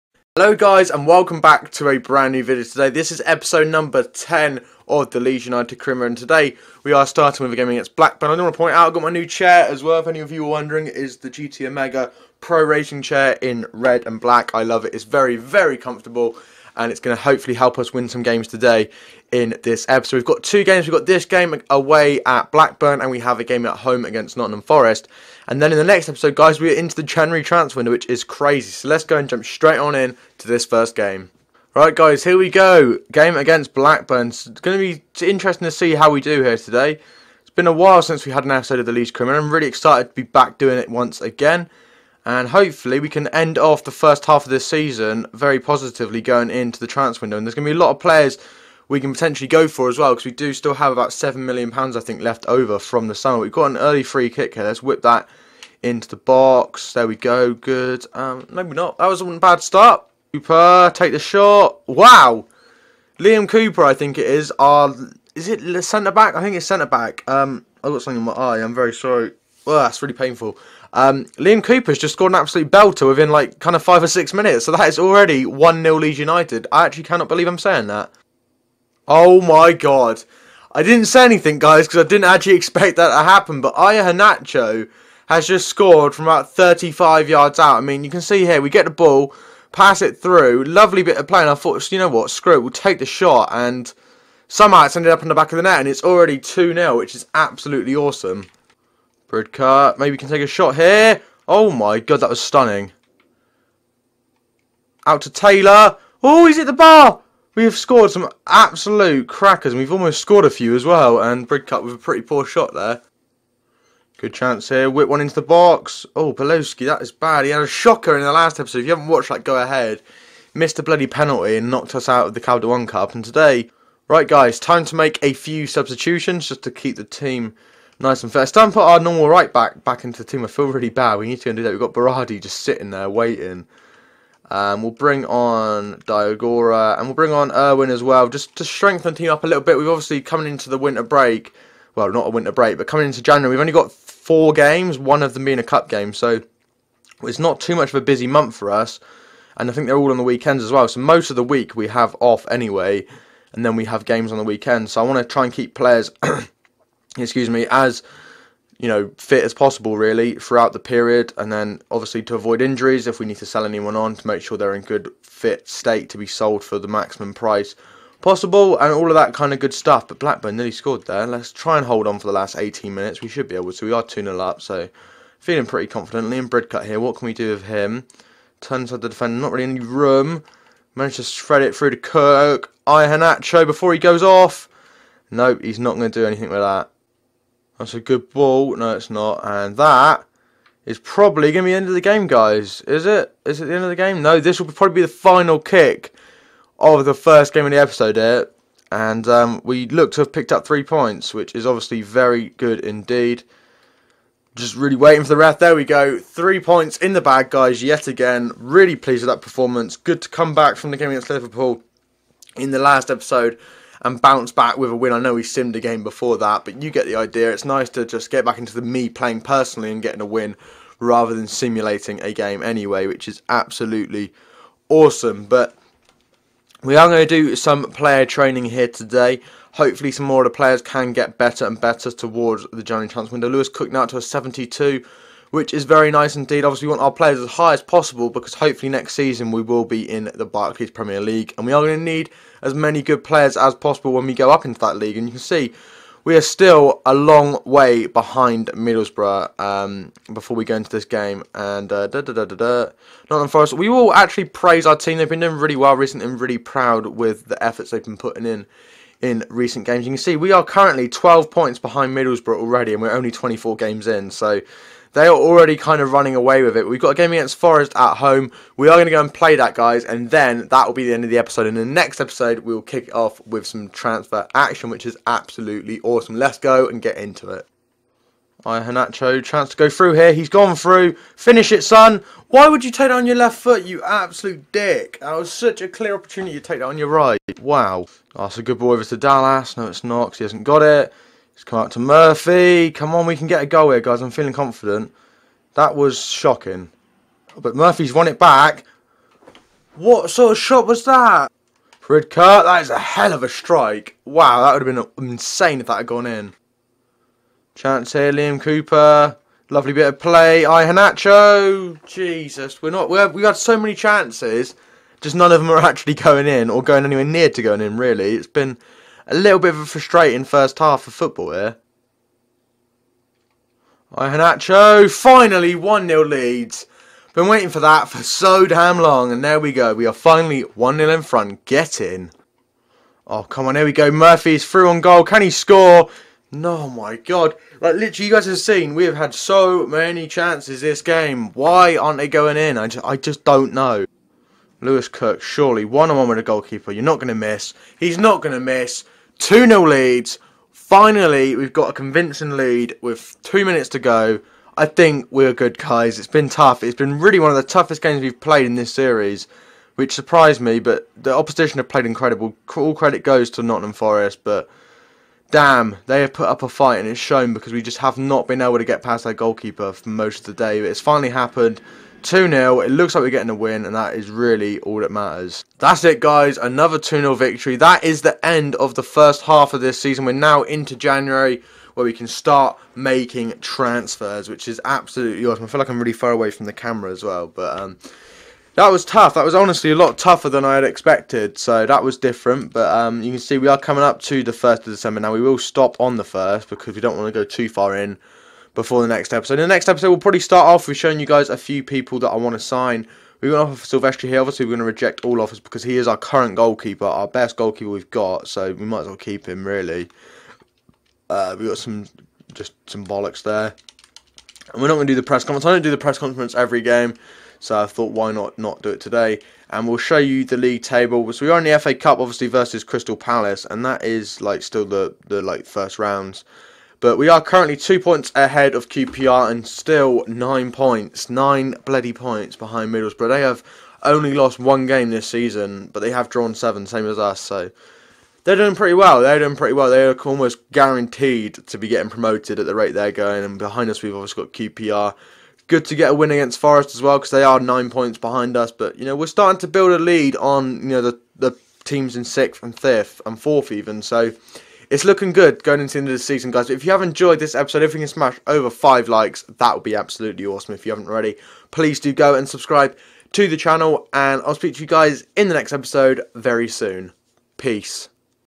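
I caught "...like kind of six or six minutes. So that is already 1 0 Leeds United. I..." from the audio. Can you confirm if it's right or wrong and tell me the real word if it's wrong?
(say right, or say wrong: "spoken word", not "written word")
wrong: "five", not "six".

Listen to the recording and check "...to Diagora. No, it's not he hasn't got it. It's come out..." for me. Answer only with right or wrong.
wrong.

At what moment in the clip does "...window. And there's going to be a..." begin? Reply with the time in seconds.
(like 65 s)
47 s.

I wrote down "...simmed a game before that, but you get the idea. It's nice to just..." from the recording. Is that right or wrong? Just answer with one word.
right.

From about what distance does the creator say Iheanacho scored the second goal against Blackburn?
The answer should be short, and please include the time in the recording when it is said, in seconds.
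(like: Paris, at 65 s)
35 yards, at 86 s.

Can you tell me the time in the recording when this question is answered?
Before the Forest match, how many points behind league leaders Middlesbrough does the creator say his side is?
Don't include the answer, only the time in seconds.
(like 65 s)
261 s.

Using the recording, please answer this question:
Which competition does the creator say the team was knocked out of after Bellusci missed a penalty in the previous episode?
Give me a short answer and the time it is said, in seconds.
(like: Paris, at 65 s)
Capital One Cup, at 122 s.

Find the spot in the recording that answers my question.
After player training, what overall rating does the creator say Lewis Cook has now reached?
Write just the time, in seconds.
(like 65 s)
234 s.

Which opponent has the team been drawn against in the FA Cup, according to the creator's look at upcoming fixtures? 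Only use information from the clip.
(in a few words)
Crystal Palace.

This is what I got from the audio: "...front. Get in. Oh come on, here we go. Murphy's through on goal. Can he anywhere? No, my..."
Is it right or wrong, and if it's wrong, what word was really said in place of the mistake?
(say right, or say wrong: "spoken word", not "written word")
wrong: "score", not "anywhere".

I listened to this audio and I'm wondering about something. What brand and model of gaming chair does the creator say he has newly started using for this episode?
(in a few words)
GT Omega Pro Racing Chair.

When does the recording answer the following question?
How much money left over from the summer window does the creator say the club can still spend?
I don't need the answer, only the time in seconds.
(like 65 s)
51 s.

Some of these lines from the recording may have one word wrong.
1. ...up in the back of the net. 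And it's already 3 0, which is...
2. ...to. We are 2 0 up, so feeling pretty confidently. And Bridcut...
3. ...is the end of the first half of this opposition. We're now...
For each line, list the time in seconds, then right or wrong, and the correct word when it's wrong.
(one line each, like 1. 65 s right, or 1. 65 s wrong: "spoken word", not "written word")
1. 95 s wrong: "2", not "3"
2. 173 s right
3. 378 s wrong: "season", not "opposition".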